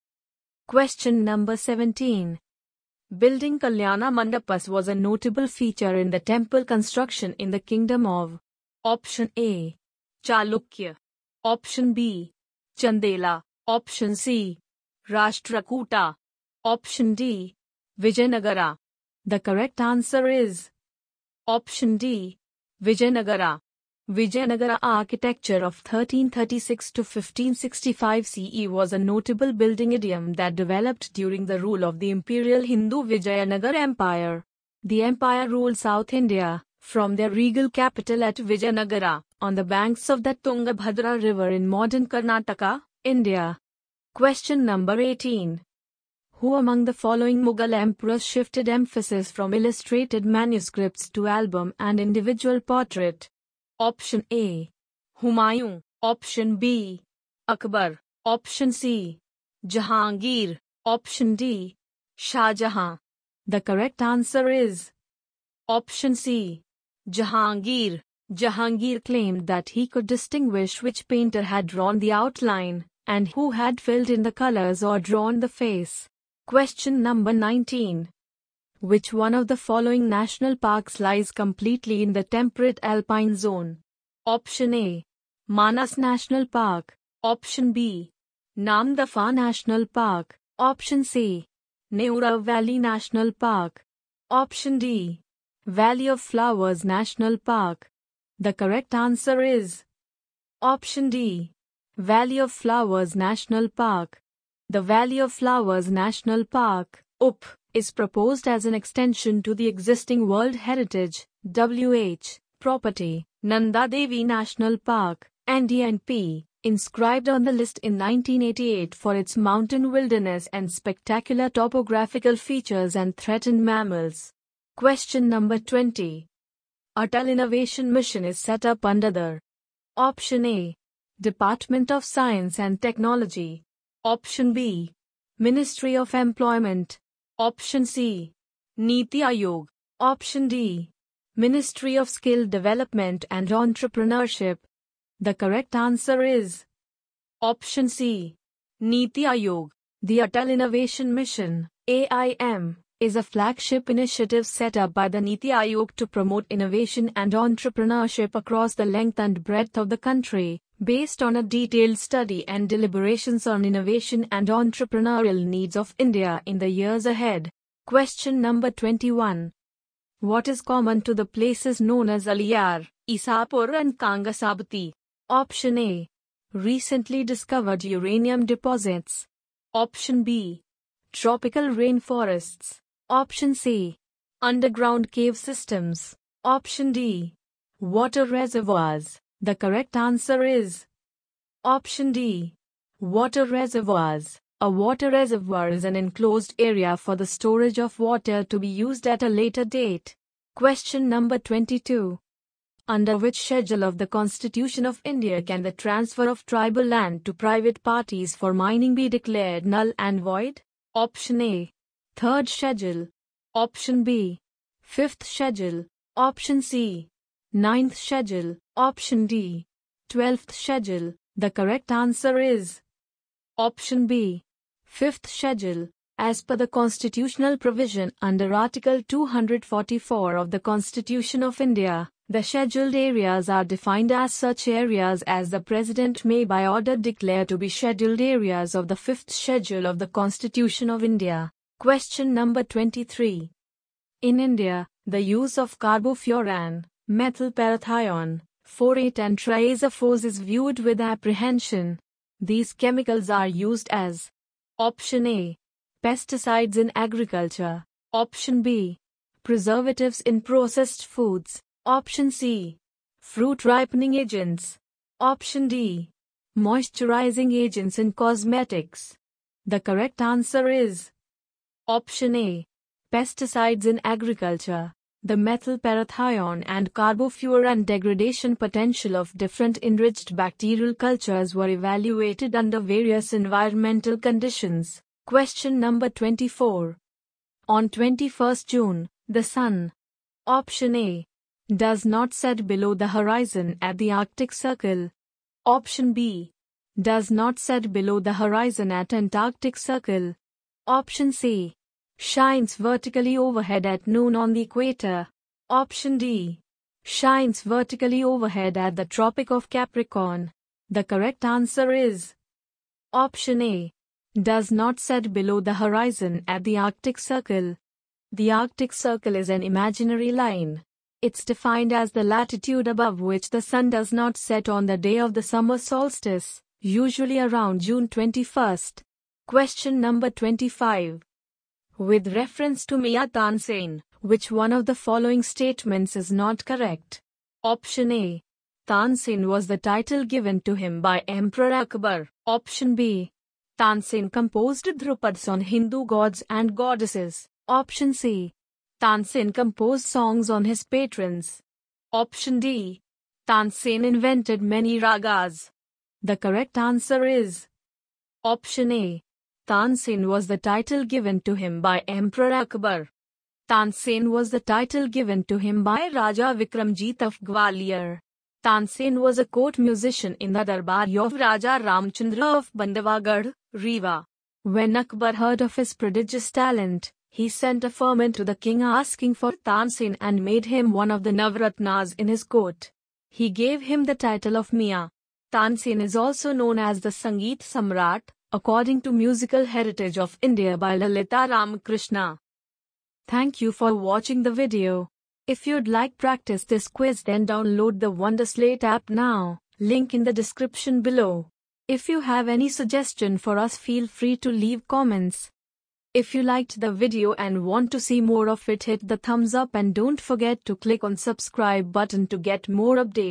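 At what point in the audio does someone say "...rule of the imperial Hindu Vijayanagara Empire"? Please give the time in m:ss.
0:31.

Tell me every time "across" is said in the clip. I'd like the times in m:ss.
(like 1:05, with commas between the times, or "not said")
2:38.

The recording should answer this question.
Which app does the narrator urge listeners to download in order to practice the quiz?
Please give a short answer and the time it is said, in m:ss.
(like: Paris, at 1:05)
Wonderslate, at 6:38.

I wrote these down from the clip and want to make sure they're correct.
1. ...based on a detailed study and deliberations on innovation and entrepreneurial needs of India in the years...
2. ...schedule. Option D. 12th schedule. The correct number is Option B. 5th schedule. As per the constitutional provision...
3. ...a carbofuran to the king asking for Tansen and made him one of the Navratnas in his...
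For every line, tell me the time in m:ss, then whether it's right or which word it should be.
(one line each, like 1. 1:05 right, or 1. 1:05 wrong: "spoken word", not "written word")
1. 2:40 right
2. 3:37 wrong: "answer", not "number"
3. 6:17 wrong: "firman", not "carbofuran".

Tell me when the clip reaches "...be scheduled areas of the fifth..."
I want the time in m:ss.
3:57.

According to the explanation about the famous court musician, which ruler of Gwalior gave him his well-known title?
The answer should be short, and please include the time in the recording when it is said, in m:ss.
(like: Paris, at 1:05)
Raja Vikramjit, at 6:06.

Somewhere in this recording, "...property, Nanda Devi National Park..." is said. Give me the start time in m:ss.
1:52.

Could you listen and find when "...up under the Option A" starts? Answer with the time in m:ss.
2:08.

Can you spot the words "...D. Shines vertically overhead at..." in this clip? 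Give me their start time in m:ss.
5:06.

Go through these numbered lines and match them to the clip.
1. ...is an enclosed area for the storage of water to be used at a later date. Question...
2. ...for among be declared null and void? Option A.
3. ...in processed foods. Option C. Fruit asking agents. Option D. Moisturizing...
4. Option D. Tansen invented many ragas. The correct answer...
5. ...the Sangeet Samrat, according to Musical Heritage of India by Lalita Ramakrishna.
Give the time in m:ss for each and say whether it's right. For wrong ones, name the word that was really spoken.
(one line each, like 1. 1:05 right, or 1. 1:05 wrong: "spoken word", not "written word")
1. 3:15 right
2. 3:28 wrong: "mining", not "among"
3. 4:20 wrong: "ripening", not "asking"
4. 5:52 right
5. 6:26 right.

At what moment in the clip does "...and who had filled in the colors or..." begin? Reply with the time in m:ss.
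1:13.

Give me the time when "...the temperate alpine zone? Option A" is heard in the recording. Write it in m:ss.
1:22.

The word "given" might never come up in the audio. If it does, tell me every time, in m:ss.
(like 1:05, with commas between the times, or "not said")
5:40, 6:01, 6:05.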